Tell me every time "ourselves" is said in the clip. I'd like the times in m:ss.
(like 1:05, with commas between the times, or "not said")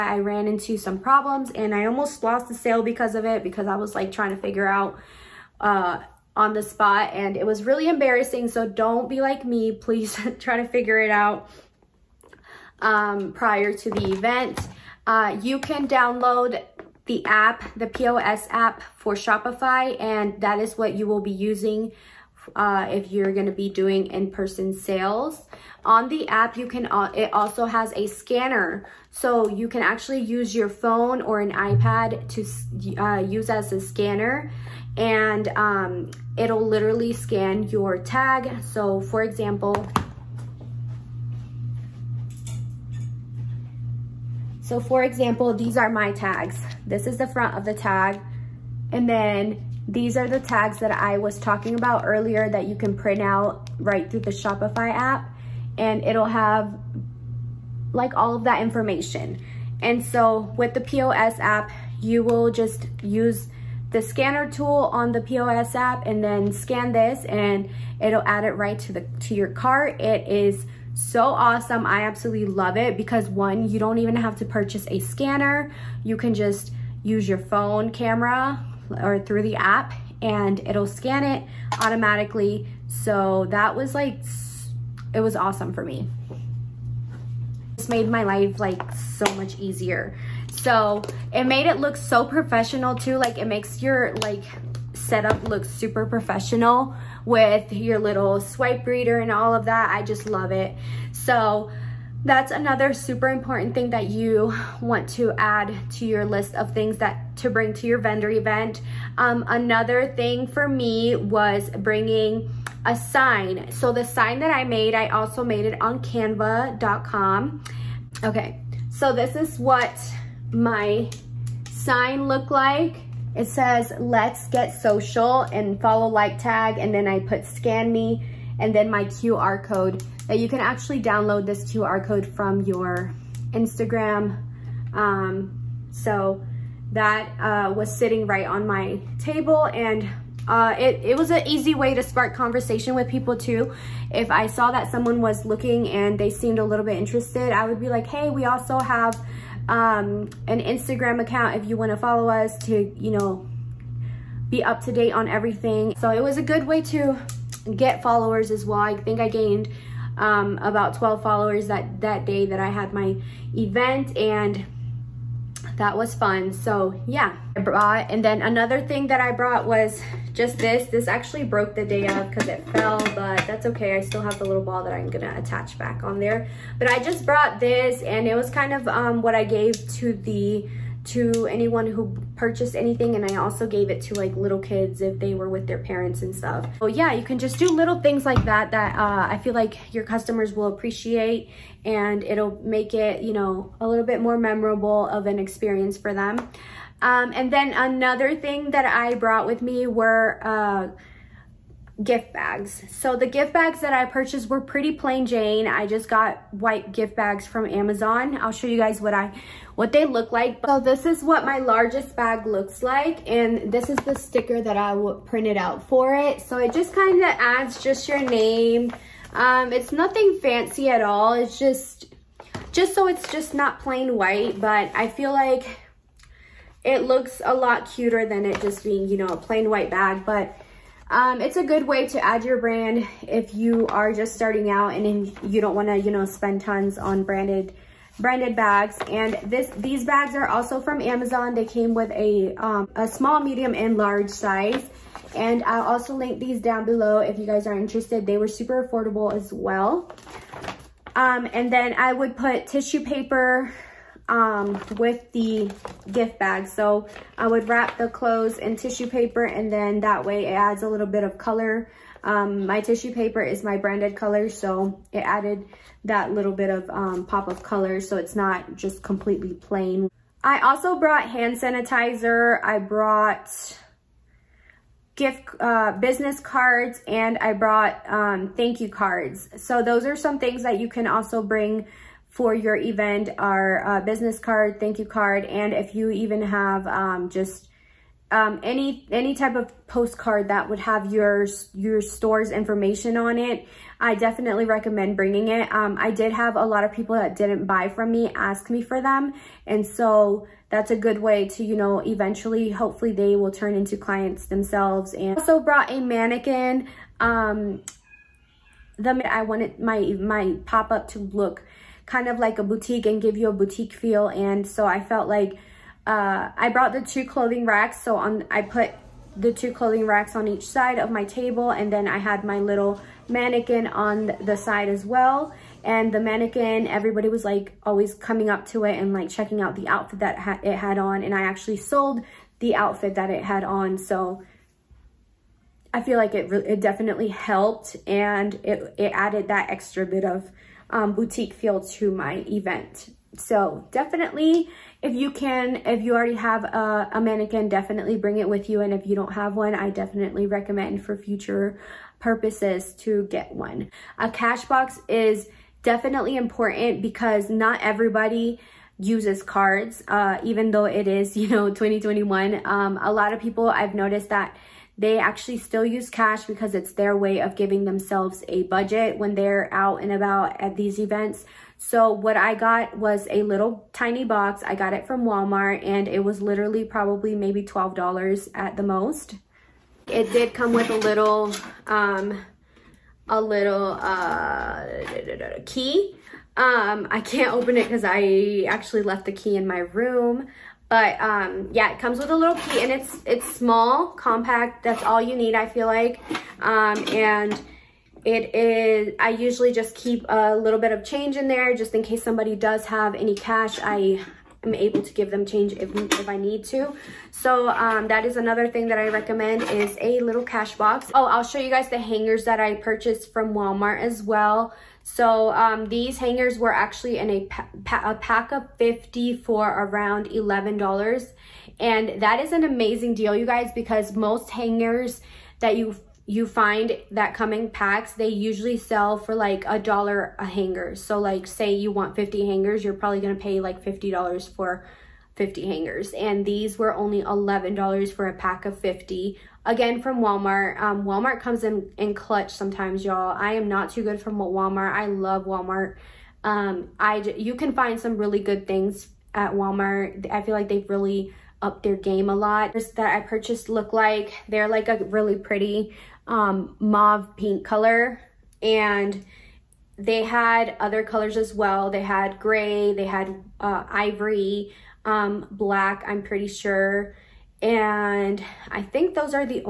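not said.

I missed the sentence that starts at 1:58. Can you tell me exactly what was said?
Okay, so this is what my sign look like?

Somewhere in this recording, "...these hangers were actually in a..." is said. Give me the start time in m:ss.
6:55.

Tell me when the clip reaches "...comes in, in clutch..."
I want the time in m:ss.
7:21.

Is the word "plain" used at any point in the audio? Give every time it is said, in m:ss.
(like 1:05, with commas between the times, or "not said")
3:24, 3:43, 3:49, 4:29.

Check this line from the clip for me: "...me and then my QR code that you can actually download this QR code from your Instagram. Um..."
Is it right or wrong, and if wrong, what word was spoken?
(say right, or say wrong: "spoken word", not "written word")
right.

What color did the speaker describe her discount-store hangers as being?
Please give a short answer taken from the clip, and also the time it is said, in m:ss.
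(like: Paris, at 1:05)
mauve pink, at 7:36.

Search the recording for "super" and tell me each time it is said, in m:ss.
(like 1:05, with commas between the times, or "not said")
1:35, 1:42, 4:08.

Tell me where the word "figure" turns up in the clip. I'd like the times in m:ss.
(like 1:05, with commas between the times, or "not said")
0:04, 0:10.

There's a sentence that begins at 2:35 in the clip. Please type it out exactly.
So it was a good way to get followers as well.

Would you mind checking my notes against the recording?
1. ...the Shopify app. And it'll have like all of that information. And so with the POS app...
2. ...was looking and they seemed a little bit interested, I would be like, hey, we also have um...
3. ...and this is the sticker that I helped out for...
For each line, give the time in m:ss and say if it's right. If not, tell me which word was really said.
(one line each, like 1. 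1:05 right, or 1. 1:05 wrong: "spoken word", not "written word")
1. 0:54 right
2. 2:25 right
3. 3:33 wrong: "printed", not "helped".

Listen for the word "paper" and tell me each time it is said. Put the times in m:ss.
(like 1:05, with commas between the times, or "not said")
4:13, 4:19, 4:23.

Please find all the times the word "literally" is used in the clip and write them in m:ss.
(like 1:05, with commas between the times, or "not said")
0:36, 6:16.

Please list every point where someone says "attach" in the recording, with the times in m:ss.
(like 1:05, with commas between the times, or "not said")
2:55.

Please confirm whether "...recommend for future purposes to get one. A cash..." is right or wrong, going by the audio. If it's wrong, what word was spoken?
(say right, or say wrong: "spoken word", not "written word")
right.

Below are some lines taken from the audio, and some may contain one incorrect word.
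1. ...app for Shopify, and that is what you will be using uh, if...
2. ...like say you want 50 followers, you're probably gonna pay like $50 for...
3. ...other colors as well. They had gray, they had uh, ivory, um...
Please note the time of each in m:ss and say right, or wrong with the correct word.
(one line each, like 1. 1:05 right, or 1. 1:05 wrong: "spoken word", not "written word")
1. 0:18 right
2. 7:11 wrong: "hangers", not "followers"
3. 7:40 right.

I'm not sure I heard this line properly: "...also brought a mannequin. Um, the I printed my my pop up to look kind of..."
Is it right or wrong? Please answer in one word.
wrong.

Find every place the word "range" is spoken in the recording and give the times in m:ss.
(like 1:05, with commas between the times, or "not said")
not said.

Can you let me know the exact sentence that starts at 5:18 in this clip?
So on, I put the two clothing racks on each side of my table.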